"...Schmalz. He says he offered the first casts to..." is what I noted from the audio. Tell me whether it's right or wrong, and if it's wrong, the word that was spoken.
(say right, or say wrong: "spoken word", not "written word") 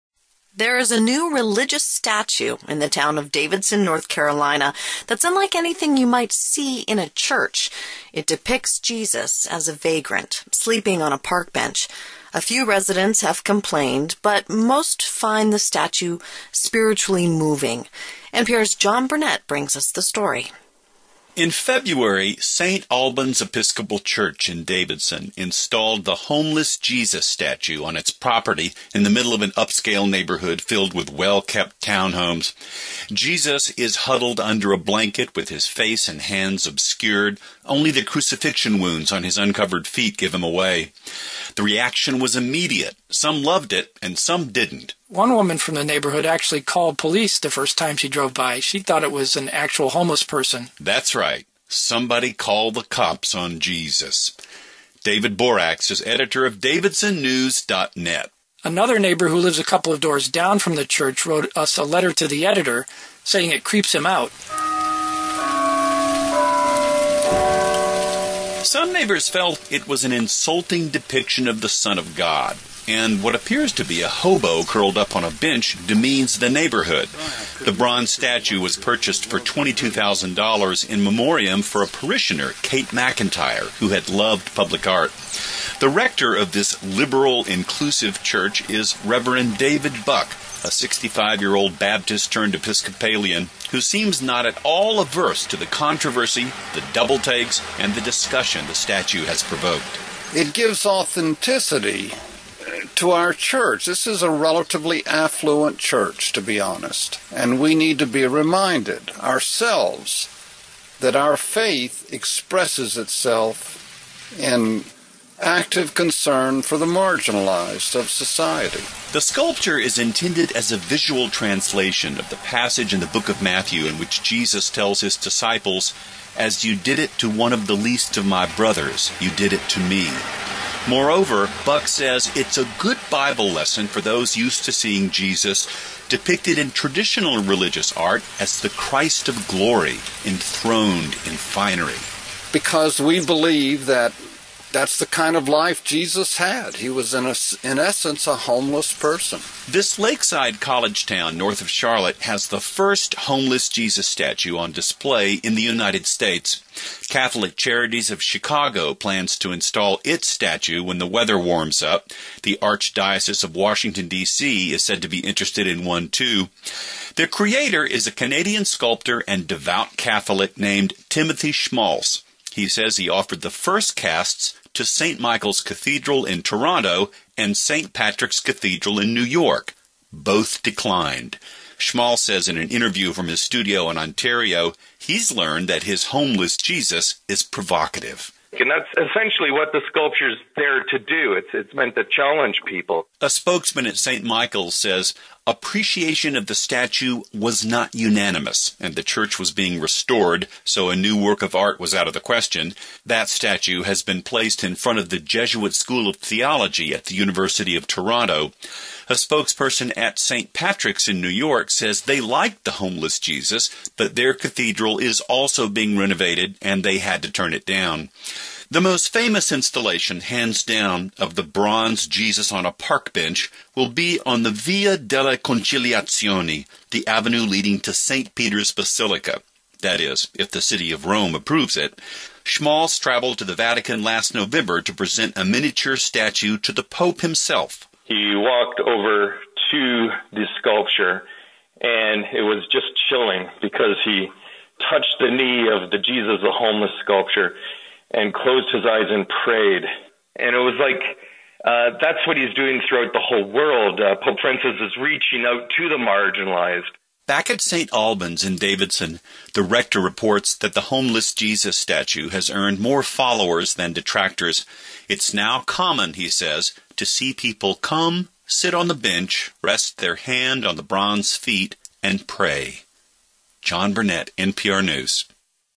right.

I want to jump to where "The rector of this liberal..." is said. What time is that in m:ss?
1:25.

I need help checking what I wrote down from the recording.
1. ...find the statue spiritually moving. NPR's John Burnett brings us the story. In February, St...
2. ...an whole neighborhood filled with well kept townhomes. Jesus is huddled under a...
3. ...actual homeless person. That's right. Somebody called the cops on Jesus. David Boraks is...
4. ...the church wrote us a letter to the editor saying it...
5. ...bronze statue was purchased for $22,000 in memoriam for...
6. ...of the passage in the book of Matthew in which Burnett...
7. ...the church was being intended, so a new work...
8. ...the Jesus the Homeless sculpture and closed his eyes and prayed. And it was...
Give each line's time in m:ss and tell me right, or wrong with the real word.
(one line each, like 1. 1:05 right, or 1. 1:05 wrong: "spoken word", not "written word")
1. 0:15 right
2. 0:29 wrong: "upscale", not "whole"
3. 0:49 right
4. 1:00 right
5. 1:17 right
6. 2:02 wrong: "Jesus", not "Burnett"
7. 3:18 wrong: "restored", not "intended"
8. 4:05 right.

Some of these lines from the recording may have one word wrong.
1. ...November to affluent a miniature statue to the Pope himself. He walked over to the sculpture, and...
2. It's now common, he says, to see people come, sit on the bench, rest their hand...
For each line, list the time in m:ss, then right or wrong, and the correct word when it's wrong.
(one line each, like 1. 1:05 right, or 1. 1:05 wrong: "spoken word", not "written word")
1. 3:54 wrong: "present", not "affluent"
2. 4:25 right.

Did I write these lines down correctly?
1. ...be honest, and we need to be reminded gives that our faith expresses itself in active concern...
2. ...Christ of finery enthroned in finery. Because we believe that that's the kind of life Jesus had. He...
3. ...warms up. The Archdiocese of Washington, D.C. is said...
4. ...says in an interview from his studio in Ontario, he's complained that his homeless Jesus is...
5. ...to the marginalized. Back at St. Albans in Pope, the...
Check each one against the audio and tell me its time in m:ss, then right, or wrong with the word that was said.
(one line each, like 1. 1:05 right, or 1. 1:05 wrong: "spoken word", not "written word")
1. 1:46 wrong: "ourselves", not "gives"
2. 2:18 wrong: "glory", not "finery"
3. 2:41 right
4. 3:02 wrong: "learned", not "complained"
5. 4:15 wrong: "Davidson", not "Pope".